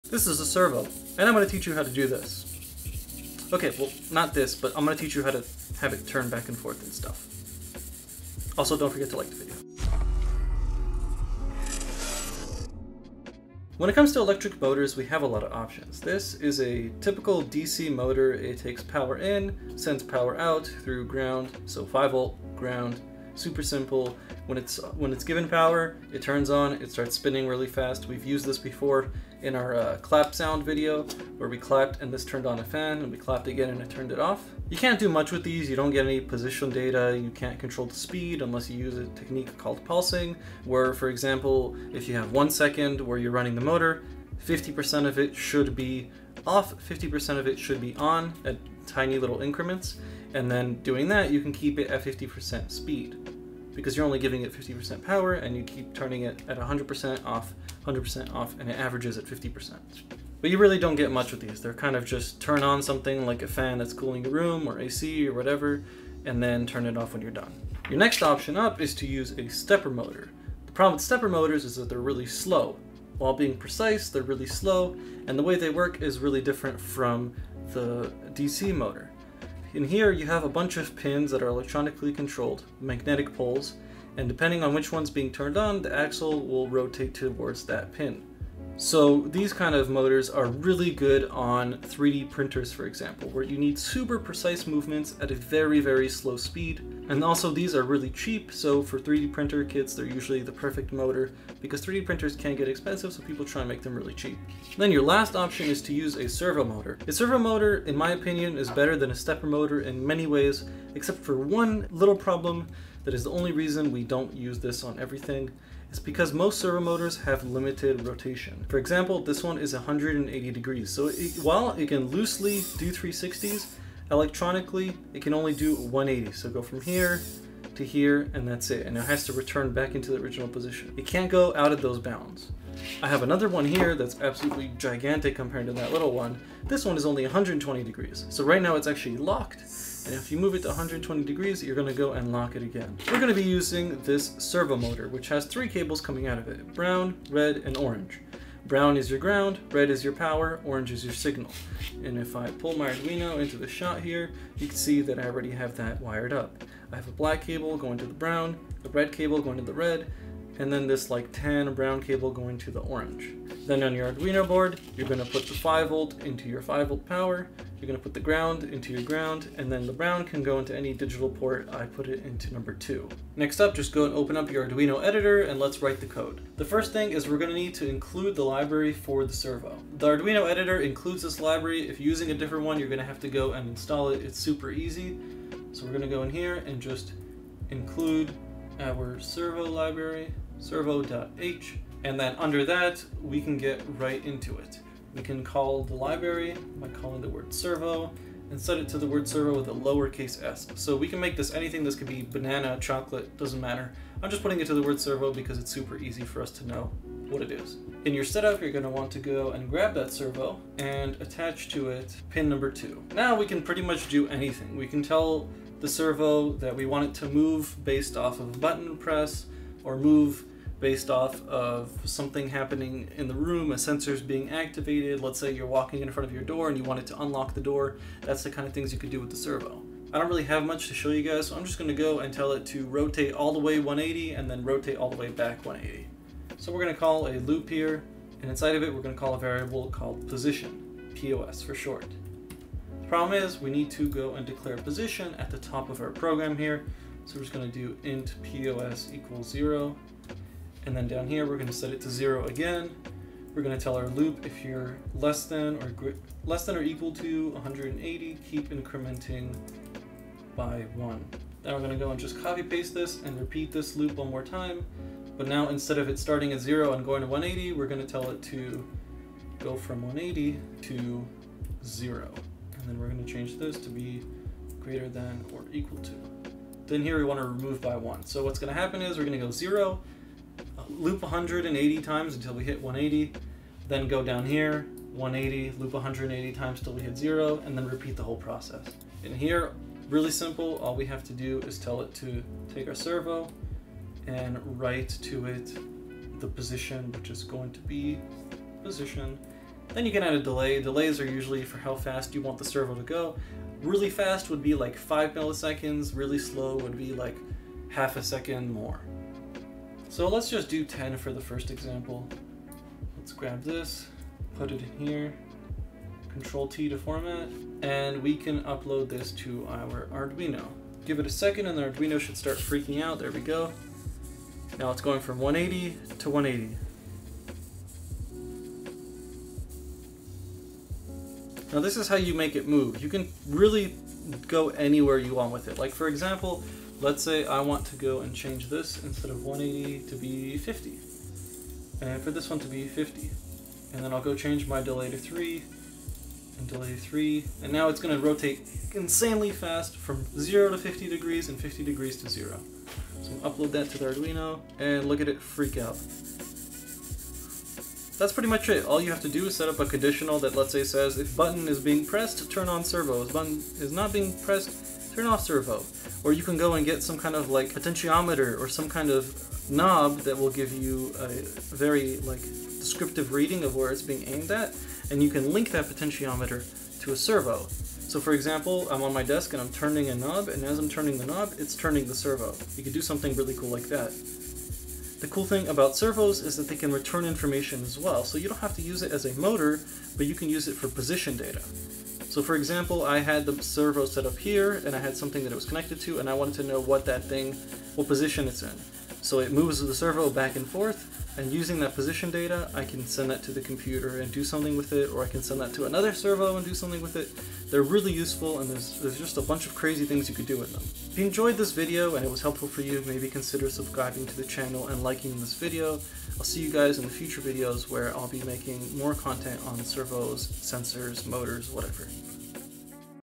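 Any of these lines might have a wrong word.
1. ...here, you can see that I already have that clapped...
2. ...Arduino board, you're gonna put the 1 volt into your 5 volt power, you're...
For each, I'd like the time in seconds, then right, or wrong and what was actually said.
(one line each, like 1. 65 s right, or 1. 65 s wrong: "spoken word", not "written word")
1. 154 s wrong: "wired", not "clapped"
2. 164 s wrong: "5", not "1".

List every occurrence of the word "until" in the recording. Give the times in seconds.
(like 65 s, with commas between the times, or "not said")
282 s.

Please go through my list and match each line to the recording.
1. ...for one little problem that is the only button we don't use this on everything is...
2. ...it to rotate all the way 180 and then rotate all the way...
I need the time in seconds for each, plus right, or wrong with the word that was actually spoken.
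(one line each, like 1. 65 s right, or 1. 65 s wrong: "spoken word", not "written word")
1. 111 s wrong: "reason", not "button"
2. 232 s right.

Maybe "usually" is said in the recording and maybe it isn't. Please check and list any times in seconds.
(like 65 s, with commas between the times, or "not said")
100 s, 301 s.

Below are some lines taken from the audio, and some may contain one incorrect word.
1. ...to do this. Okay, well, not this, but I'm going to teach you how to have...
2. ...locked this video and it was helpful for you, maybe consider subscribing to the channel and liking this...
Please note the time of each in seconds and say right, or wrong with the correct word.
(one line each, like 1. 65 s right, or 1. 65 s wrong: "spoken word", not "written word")
1. 1 s right
2. 411 s wrong: "enjoyed", not "locked".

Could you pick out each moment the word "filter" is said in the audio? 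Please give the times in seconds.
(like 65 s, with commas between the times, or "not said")
not said.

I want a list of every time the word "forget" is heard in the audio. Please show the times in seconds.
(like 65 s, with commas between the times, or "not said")
8 s.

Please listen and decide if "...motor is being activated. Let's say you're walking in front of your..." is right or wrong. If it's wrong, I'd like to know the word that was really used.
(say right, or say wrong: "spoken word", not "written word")
wrong: "sensor", not "motor".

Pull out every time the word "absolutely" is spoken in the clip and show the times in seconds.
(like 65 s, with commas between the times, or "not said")
134 s.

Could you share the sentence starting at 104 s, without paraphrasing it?
Then your last option is to use a servo motor.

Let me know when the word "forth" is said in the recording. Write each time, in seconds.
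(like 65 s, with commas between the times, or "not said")
6 s, 400 s.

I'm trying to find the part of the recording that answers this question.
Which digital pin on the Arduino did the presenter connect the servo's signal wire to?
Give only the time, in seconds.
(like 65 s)
172 s.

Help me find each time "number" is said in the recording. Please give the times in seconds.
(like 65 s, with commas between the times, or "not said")
172 s, 212 s.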